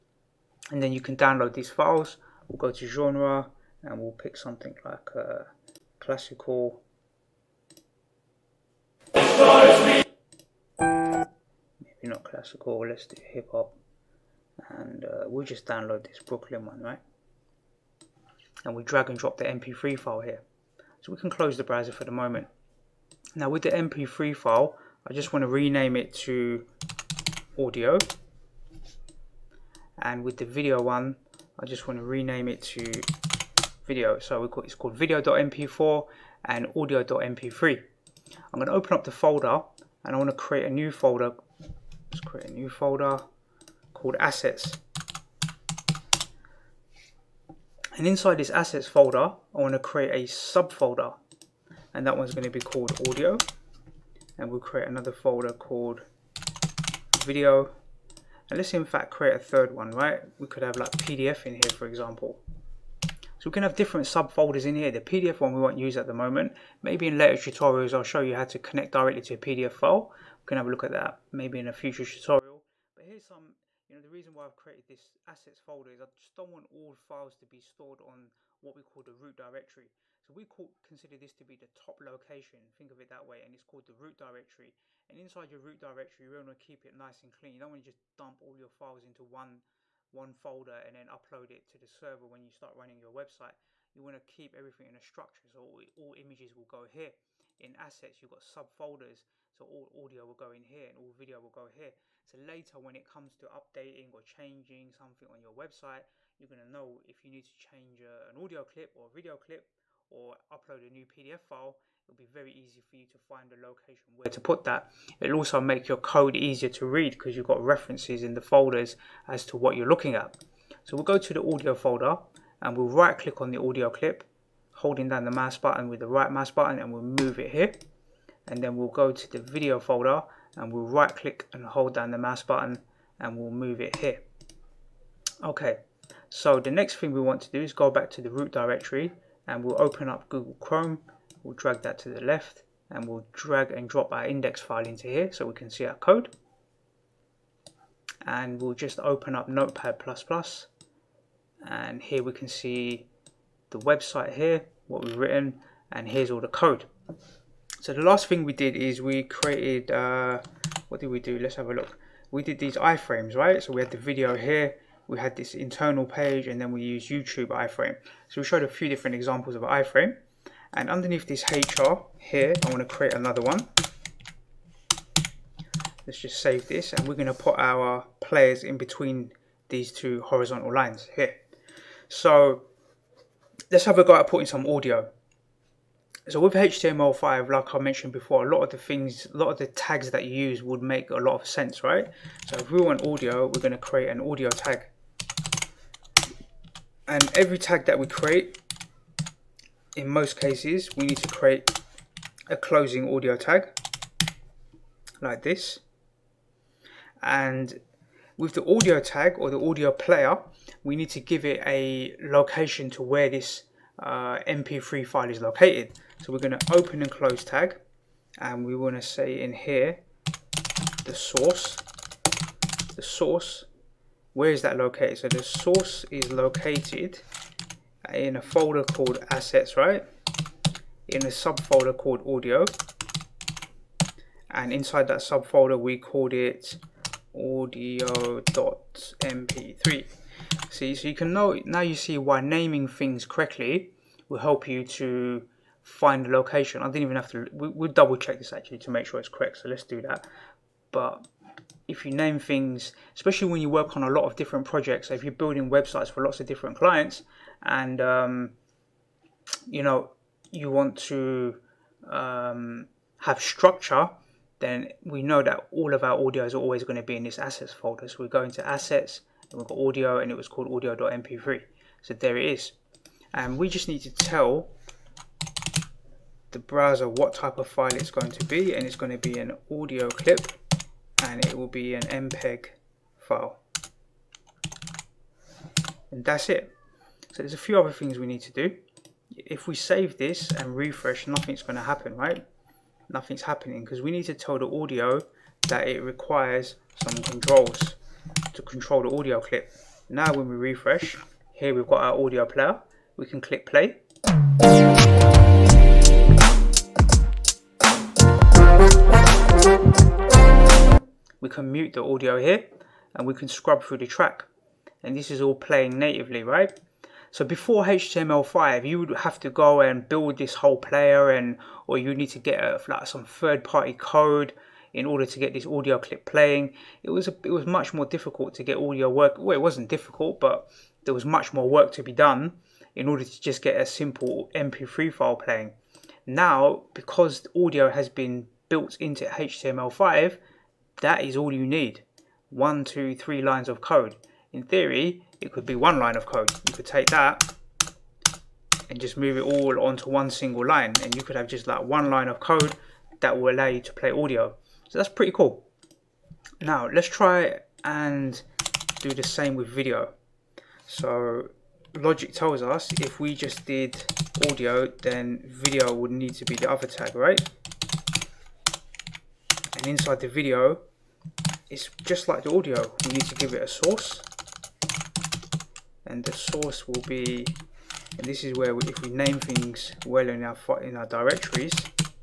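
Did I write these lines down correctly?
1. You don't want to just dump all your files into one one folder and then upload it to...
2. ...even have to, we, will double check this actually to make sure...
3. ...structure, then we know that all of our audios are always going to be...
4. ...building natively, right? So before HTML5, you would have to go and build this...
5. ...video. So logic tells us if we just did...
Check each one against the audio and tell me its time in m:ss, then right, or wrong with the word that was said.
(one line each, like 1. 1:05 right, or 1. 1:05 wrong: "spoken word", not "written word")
1. 1:27 right
2. 4:07 right
3. 4:23 right
4. 5:15 wrong: "playing", not "building"
5. 5:59 right.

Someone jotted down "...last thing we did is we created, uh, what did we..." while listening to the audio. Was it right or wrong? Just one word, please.
right.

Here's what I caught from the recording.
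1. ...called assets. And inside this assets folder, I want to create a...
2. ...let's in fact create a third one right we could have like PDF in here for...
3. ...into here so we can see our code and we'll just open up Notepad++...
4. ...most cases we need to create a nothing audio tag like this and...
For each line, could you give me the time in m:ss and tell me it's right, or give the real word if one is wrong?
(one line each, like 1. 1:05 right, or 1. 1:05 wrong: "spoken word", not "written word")
1. 0:43 right
2. 0:58 right
3. 2:24 right
4. 3:20 wrong: "closing", not "nothing".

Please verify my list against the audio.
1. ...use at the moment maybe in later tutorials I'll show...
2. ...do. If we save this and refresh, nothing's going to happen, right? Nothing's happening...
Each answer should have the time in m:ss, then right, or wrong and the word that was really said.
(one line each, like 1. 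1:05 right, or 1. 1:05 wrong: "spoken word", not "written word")
1. 1:05 right
2. 4:48 right.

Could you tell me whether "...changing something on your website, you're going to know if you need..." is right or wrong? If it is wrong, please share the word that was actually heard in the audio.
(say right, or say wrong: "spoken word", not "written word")
right.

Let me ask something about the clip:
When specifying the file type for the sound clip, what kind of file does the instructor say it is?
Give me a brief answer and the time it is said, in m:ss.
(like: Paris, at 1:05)
MPEG, at 4:42.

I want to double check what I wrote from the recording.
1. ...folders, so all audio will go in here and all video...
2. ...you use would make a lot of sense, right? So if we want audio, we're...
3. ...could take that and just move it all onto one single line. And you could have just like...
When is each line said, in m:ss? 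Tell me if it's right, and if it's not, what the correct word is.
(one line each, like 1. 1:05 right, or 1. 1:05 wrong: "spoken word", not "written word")
1. 1:38 wrong: "subfolders", not "folders"
2. 3:10 right
3. 5:46 right.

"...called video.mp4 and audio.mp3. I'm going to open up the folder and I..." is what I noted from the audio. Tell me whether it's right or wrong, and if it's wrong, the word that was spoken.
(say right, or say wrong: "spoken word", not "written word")
right.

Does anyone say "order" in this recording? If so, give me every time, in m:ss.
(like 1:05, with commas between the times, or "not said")
5:25, 5:33.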